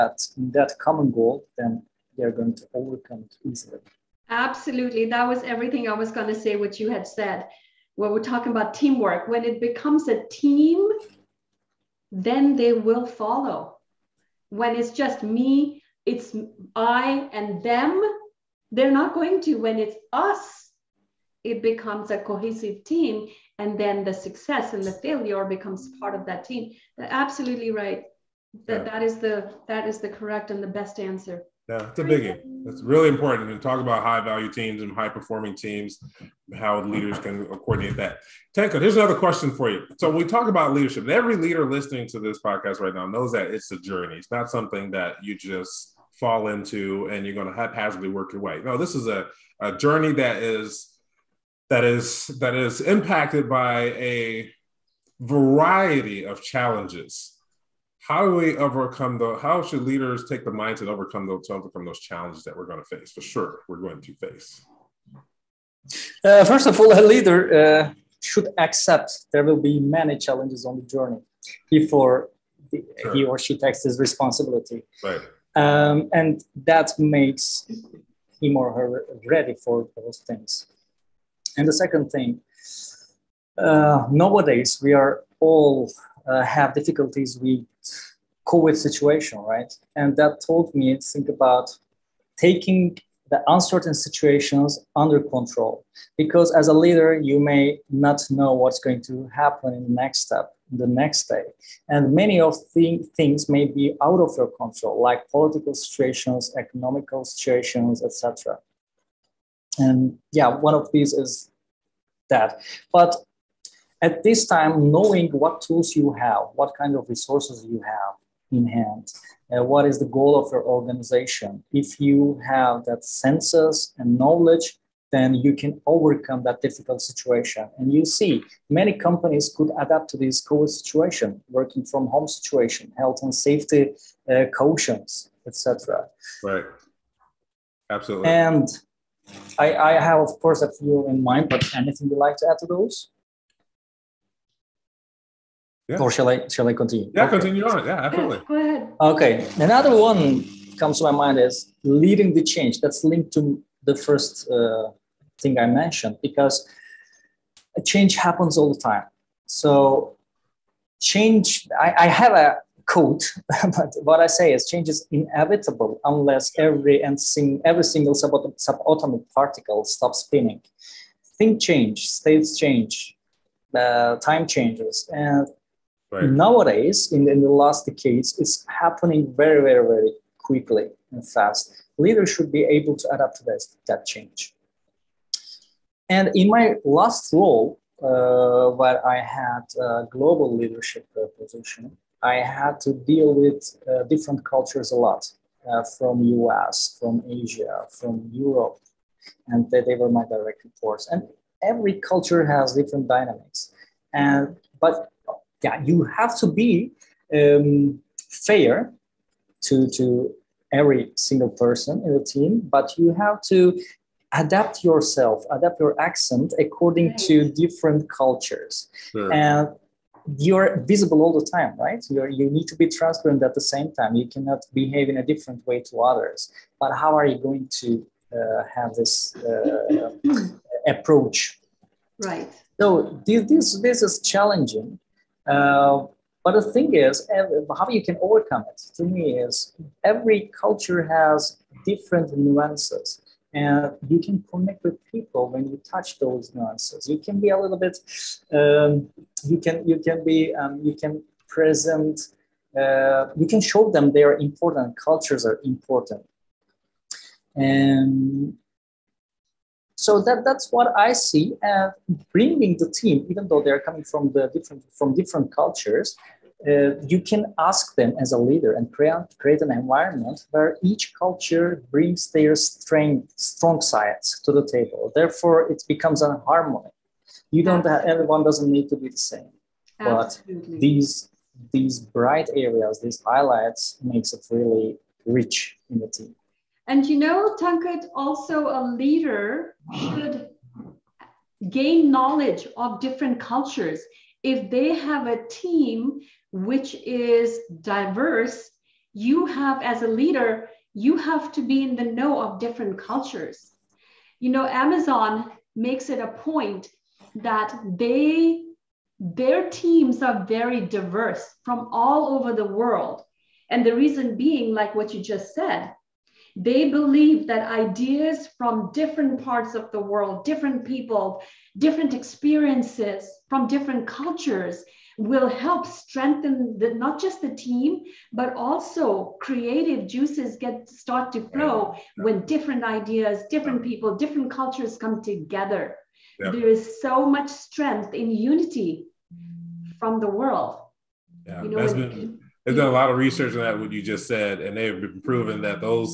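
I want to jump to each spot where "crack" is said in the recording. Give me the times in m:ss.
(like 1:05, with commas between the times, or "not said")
not said.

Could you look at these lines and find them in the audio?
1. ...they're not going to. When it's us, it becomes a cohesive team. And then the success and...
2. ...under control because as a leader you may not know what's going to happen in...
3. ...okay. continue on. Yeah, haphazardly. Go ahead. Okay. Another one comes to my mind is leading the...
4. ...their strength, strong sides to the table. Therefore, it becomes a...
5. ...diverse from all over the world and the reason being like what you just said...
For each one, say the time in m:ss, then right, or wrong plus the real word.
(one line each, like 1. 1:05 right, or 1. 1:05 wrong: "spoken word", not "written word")
1. 0:18 right
2. 1:34 right
3. 2:27 wrong: "absolutely", not "haphazardly"
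4. 4:32 right
5. 5:10 right.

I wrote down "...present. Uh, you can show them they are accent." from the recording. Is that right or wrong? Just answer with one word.
wrong.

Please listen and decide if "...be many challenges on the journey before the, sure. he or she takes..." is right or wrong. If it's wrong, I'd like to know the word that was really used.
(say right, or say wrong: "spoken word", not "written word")
right.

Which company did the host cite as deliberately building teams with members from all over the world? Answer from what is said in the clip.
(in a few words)
Amazon.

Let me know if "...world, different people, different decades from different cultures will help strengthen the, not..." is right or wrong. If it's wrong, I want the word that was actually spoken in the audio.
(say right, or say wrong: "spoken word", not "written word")
wrong: "experiences", not "decades".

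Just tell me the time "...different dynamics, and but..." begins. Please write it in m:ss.
3:22.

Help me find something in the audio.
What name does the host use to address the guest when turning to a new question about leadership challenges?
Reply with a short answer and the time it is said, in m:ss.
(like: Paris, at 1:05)
Tenko, at 0:38.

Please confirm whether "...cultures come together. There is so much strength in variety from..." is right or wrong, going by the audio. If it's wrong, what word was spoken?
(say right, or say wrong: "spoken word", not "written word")
wrong: "unity", not "variety".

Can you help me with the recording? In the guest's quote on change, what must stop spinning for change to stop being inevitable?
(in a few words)
subatomic particle.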